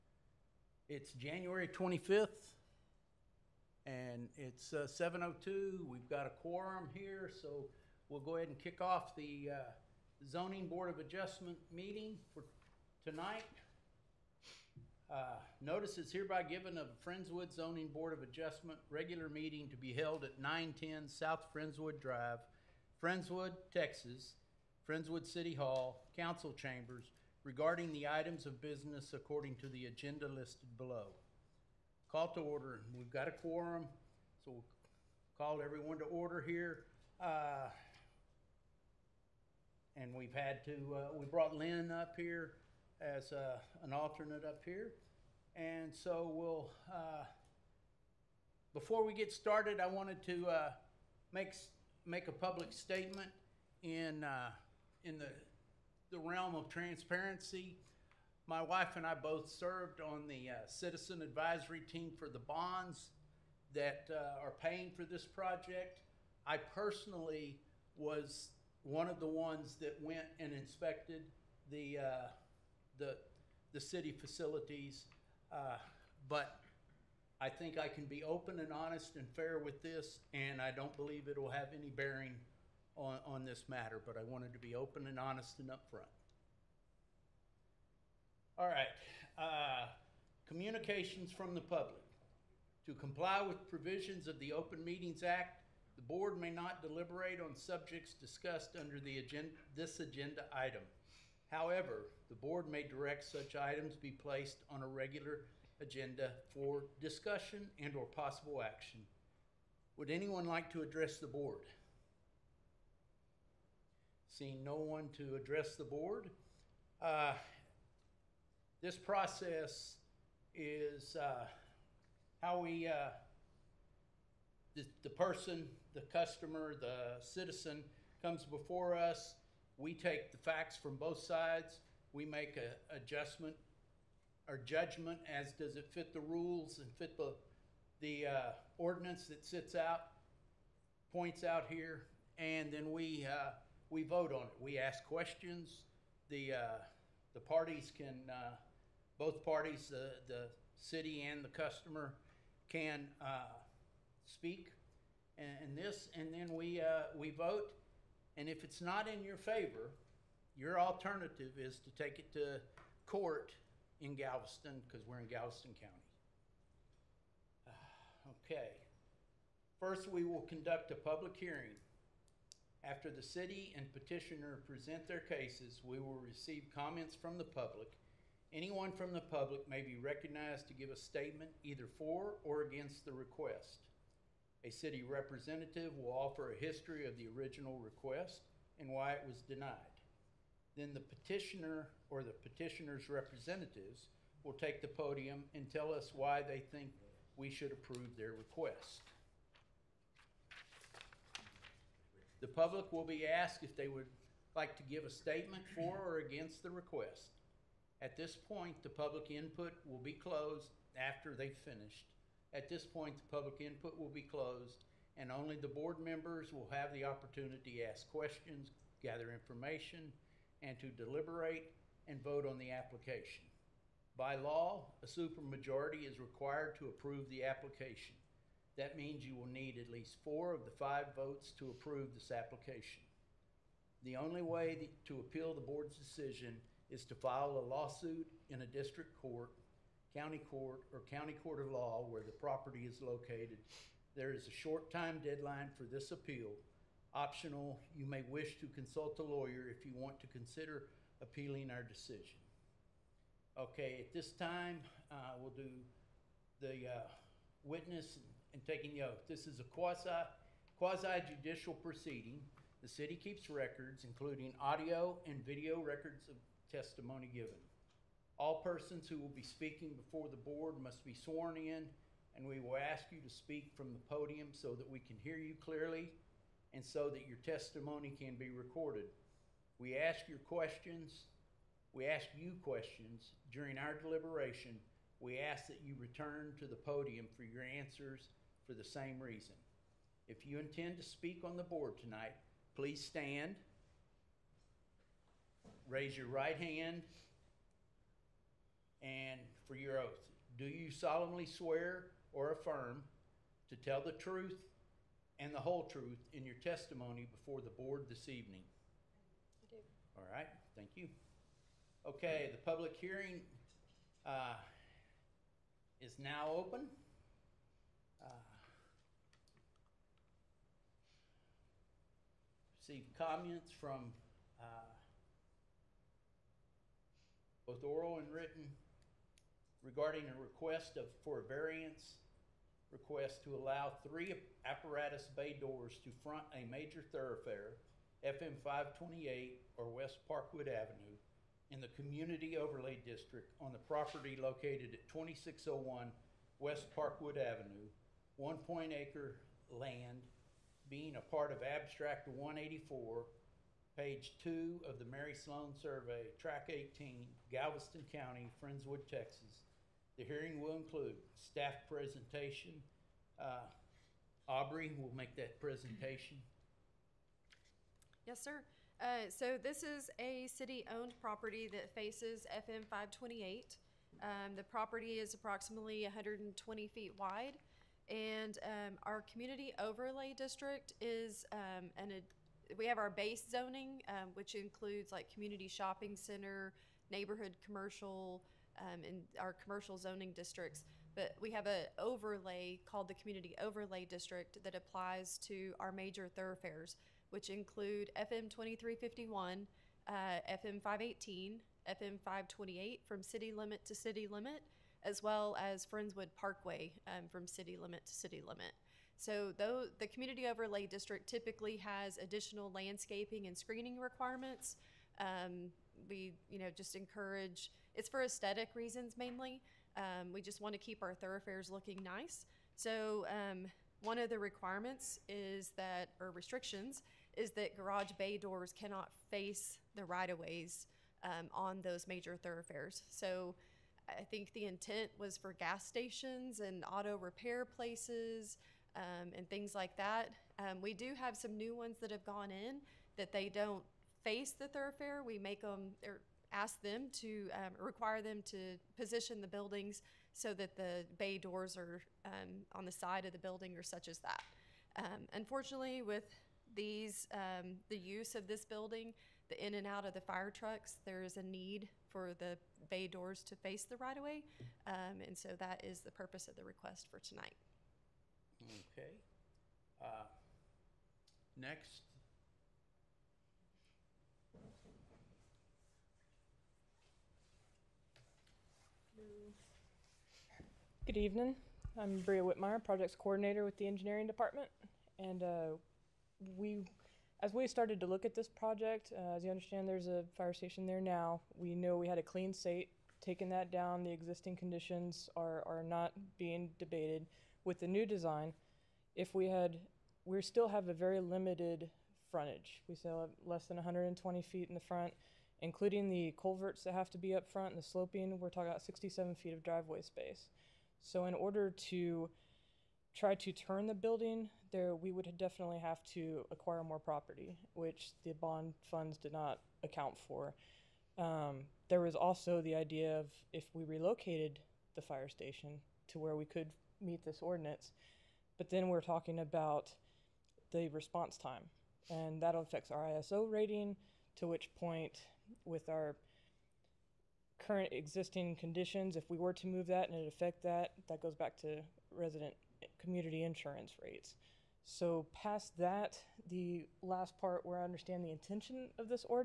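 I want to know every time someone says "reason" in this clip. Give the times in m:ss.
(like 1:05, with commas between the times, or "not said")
4:49, 6:58.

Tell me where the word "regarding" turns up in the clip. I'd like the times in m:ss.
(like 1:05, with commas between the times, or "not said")
0:27, 5:29.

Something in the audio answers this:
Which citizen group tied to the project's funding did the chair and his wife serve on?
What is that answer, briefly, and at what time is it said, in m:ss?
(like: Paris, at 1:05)
Citizen advisory team, at 1:00.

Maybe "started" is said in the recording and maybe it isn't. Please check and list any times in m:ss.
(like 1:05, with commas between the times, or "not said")
0:49, 8:07.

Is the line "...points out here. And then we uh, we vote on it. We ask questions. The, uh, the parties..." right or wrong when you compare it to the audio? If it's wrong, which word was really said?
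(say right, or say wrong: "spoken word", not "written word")
right.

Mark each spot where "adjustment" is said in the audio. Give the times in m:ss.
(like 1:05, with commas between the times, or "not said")
0:10, 0:18, 2:12.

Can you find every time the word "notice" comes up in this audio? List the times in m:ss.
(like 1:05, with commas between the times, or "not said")
0:15.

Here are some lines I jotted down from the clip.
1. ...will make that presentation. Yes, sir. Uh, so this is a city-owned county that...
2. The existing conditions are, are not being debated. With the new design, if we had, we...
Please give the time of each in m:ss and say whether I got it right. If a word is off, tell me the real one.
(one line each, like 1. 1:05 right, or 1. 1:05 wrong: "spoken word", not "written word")
1. 6:04 wrong: "property", not "county"
2. 8:14 right.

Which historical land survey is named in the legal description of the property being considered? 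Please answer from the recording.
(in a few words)
Mary Sloan Survey.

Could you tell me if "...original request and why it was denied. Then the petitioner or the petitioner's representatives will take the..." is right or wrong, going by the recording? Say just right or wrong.
right.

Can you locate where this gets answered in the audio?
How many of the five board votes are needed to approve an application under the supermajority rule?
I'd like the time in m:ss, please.
3:50.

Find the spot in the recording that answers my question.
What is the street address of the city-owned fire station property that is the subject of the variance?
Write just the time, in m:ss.
5:45.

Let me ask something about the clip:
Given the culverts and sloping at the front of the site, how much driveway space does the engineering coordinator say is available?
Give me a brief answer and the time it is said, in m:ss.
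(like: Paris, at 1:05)
67 feet, at 8:28.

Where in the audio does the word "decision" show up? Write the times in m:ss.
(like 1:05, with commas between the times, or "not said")
3:55, 4:11.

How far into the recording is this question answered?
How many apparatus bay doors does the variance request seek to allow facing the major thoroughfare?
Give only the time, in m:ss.
5:34.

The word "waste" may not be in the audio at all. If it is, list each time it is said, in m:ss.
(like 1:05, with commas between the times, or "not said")
not said.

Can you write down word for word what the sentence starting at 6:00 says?
The hearing will include staff presentation.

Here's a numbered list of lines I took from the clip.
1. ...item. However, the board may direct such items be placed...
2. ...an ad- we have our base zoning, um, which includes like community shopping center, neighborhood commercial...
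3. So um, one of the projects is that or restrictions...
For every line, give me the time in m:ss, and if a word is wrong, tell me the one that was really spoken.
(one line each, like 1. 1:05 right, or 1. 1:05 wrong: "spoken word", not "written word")
1. 1:40 right
2. 6:21 right
3. 7:02 wrong: "requirements", not "projects".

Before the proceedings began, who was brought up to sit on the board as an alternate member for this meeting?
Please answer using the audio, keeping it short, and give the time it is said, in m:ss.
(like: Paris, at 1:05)
Lynn, at 0:41.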